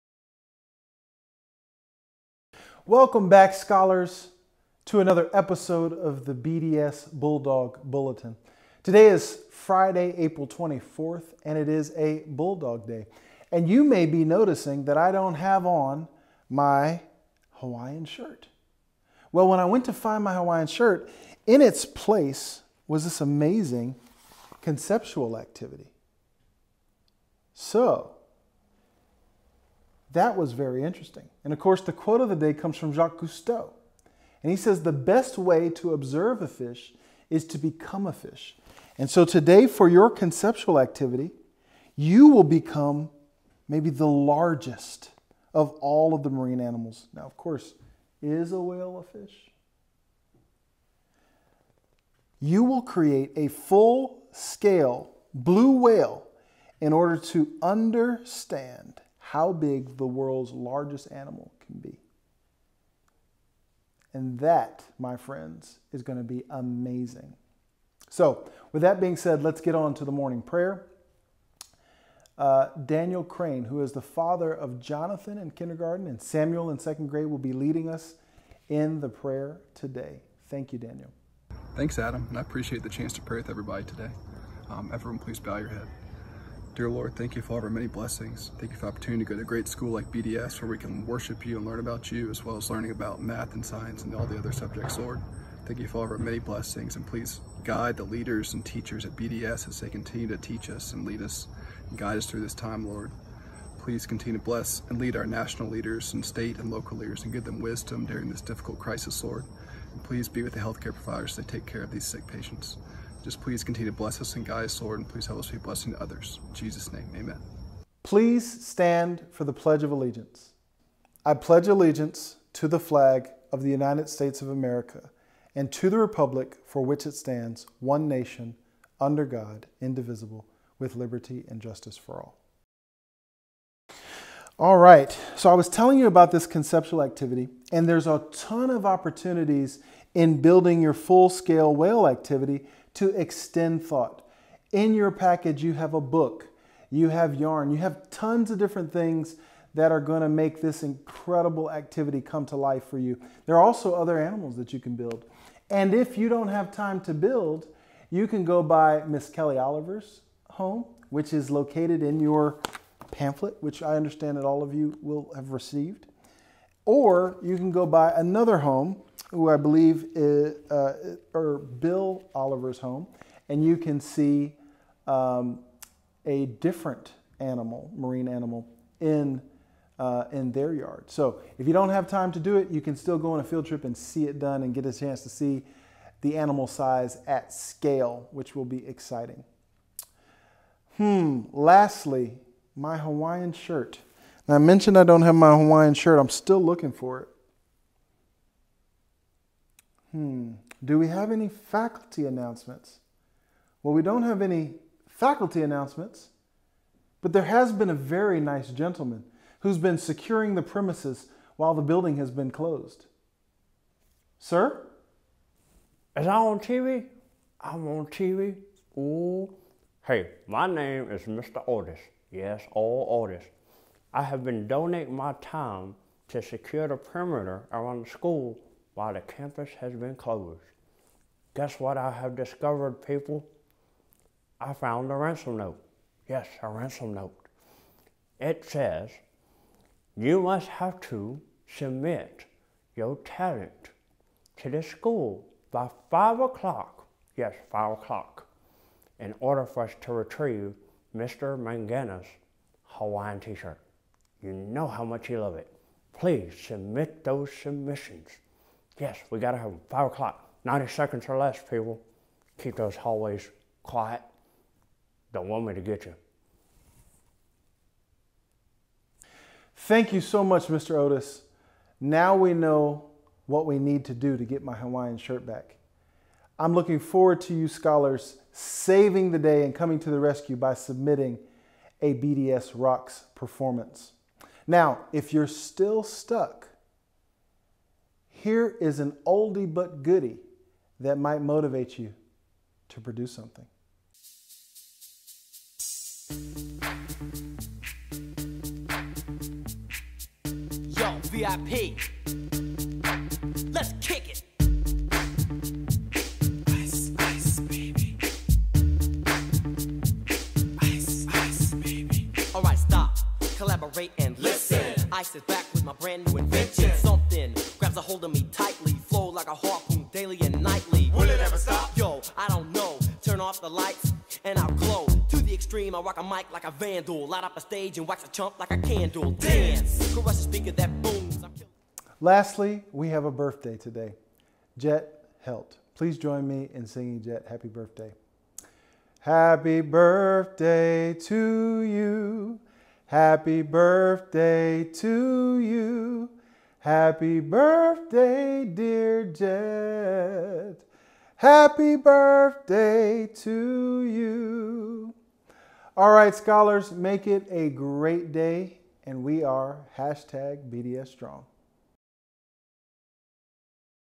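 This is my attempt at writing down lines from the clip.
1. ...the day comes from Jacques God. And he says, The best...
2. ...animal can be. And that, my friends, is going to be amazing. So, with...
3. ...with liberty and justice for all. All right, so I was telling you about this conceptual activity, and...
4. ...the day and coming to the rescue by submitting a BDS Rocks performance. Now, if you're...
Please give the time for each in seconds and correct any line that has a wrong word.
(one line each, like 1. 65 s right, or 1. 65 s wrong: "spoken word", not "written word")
1. 32 s wrong: "Cousteau", not "God"
2. 61 s right
3. 130 s right
4. 279 s right.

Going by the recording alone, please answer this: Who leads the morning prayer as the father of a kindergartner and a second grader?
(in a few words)
Daniel Crane.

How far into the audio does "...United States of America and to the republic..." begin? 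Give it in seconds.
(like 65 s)
123 s.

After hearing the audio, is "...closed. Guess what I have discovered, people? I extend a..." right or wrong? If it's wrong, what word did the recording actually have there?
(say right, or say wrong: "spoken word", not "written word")
wrong: "found", not "extend".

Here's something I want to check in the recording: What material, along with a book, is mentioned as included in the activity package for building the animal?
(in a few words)
yarn.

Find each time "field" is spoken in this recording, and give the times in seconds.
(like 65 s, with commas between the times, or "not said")
183 s.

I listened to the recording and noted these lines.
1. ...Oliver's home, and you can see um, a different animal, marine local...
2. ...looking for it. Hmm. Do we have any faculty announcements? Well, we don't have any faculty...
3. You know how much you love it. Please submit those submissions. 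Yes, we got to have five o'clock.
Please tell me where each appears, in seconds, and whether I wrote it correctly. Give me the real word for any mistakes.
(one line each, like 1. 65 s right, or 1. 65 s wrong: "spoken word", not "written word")
1. 172 s wrong: "animal", not "local"
2. 196 s right
3. 254 s right.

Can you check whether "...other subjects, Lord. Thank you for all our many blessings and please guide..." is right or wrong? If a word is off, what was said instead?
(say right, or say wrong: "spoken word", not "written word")
right.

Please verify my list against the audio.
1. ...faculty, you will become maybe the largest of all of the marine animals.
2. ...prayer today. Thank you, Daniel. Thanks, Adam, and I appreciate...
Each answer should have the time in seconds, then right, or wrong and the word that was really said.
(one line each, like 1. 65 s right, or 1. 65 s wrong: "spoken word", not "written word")
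1. 40 s wrong: "activity", not "faculty"
2. 79 s right.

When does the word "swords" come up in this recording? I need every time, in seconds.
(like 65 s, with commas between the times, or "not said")
not said.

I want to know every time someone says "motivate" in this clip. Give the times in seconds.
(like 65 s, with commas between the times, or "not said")
291 s.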